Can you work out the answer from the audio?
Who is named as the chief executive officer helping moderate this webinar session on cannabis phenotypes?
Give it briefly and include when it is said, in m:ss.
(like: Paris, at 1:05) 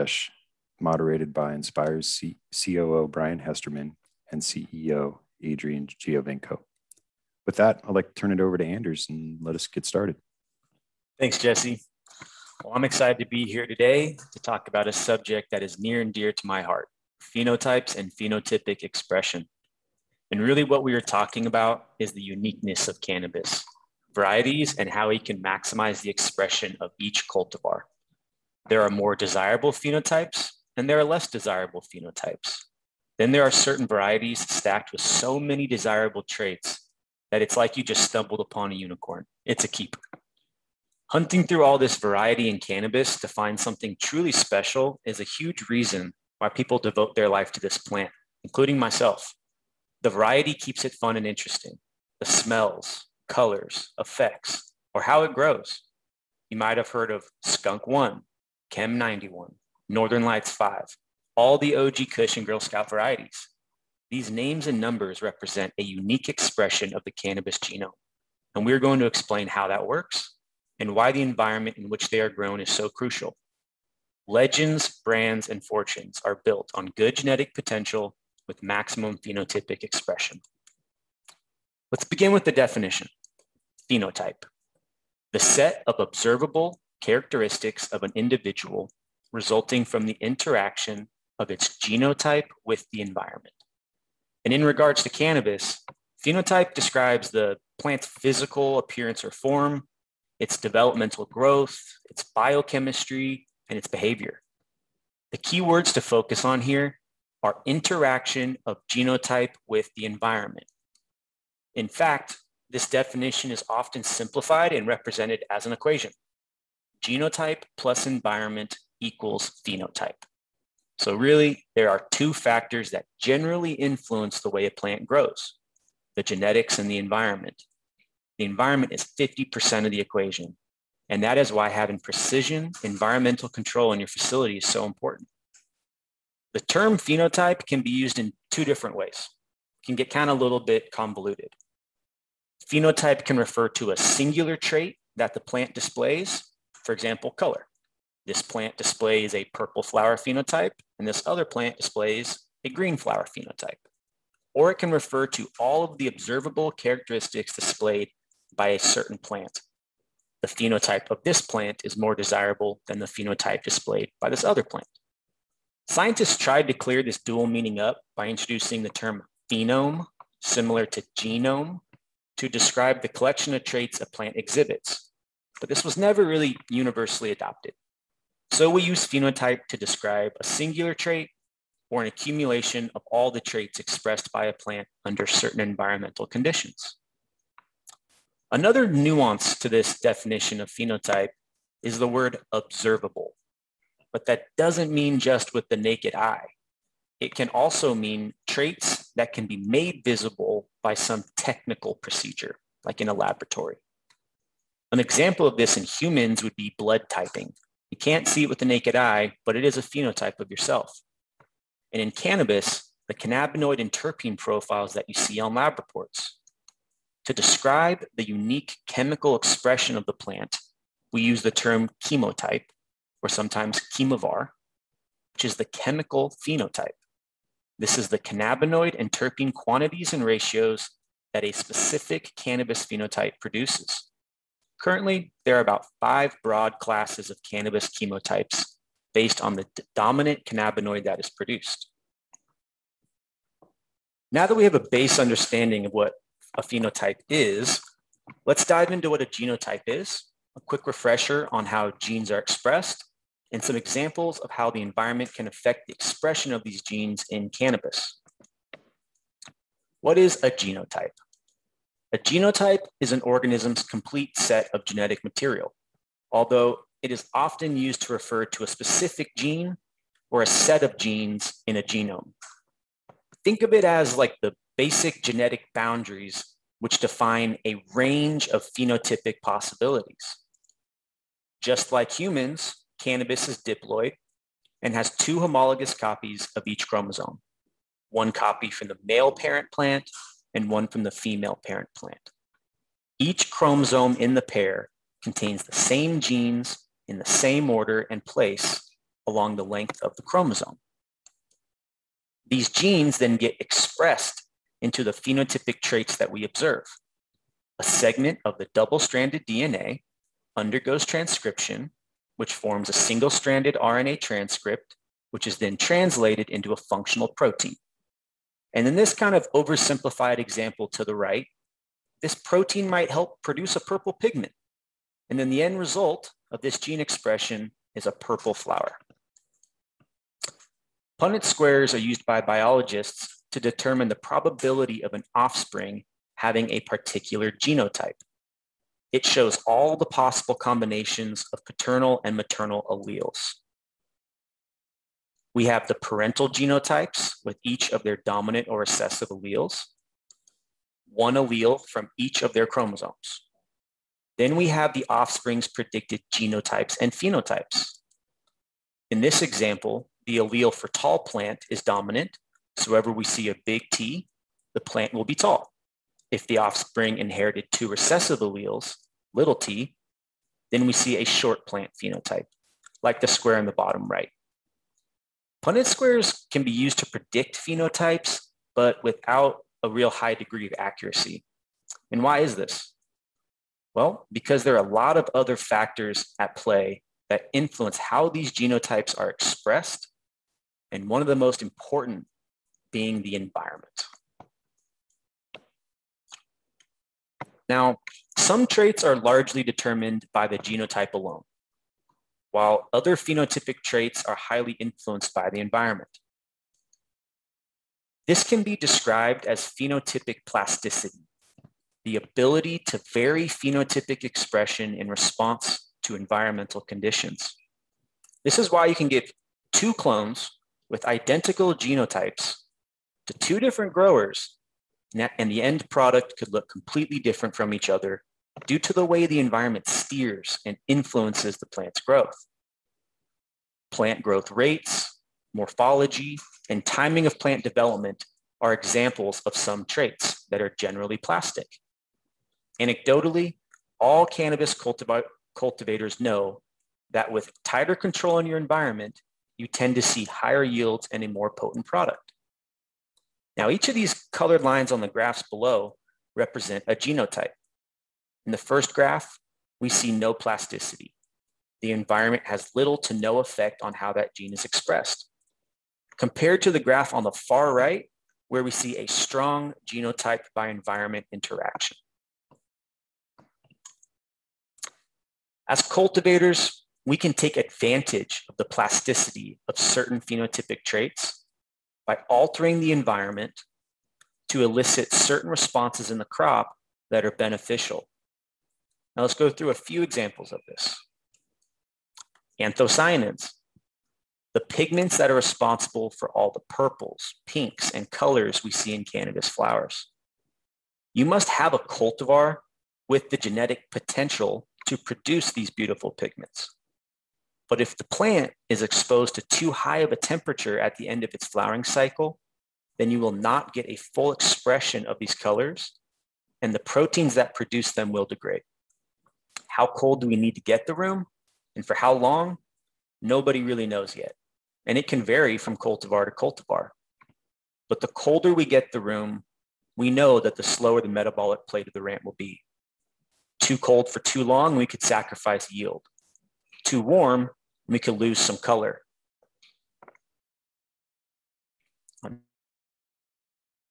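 Adrian Giovenco, at 0:05.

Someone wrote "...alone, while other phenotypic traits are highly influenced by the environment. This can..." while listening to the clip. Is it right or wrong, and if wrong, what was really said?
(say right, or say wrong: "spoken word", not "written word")
right.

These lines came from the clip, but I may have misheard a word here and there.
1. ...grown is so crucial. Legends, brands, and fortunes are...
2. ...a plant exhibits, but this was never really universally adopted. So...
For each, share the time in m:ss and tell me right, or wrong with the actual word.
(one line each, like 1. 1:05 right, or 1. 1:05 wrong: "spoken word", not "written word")
1. 1:12 right
2. 2:54 right.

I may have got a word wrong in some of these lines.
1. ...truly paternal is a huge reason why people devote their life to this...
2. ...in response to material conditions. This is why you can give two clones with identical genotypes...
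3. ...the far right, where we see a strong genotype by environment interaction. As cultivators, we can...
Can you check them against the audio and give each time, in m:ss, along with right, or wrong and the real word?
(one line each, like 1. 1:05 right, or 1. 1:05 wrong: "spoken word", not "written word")
1. 0:44 wrong: "special", not "paternal"
2. 6:54 wrong: "environmental", not "material"
3. 7:47 right.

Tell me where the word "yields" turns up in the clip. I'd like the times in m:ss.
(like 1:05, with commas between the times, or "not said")
7:30, 8:55.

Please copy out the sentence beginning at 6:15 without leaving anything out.
Punnett squares can be used to predict phenotypes, but without a real high degree of accuracy.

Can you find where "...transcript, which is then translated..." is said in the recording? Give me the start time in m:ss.
5:14.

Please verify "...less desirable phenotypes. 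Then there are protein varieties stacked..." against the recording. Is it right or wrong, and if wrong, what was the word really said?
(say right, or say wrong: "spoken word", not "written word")
wrong: "certain", not "protein".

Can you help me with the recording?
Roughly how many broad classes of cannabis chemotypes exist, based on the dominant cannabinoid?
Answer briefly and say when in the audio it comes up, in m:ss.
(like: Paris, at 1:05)
5, at 3:55.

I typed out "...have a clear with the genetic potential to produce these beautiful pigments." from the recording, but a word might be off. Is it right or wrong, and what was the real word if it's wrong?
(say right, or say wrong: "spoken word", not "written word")
wrong: "cultivar", not "clear".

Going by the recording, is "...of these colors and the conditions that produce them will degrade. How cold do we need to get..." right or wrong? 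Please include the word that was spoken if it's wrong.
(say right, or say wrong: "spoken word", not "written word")
wrong: "proteins", not "conditions".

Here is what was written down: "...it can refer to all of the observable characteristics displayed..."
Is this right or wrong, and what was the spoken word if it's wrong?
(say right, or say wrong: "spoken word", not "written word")
right.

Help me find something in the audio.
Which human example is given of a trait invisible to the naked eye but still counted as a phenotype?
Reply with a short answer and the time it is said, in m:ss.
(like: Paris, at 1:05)
blood typing, at 3:26.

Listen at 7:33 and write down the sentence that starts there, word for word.
Now, each of these colored lines on the graphs below represent a genotype.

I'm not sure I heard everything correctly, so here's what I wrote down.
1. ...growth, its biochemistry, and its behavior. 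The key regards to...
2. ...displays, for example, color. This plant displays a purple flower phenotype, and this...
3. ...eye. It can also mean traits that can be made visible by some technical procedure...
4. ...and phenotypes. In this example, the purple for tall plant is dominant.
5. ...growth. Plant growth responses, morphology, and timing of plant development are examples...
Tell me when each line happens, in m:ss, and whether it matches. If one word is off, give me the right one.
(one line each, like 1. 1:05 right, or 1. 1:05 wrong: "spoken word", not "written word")
1. 1:41 wrong: "words", not "regards"
2. 2:25 right
3. 3:16 right
4. 5:56 wrong: "allele", not "purple"
5. 7:12 wrong: "rates", not "responses".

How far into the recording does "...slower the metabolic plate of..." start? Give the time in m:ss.
8:50.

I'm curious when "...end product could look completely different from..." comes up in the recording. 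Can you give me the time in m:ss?
7:05.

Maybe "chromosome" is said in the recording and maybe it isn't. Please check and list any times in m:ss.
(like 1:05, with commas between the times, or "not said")
4:46, 4:53, 5:00, 5:52.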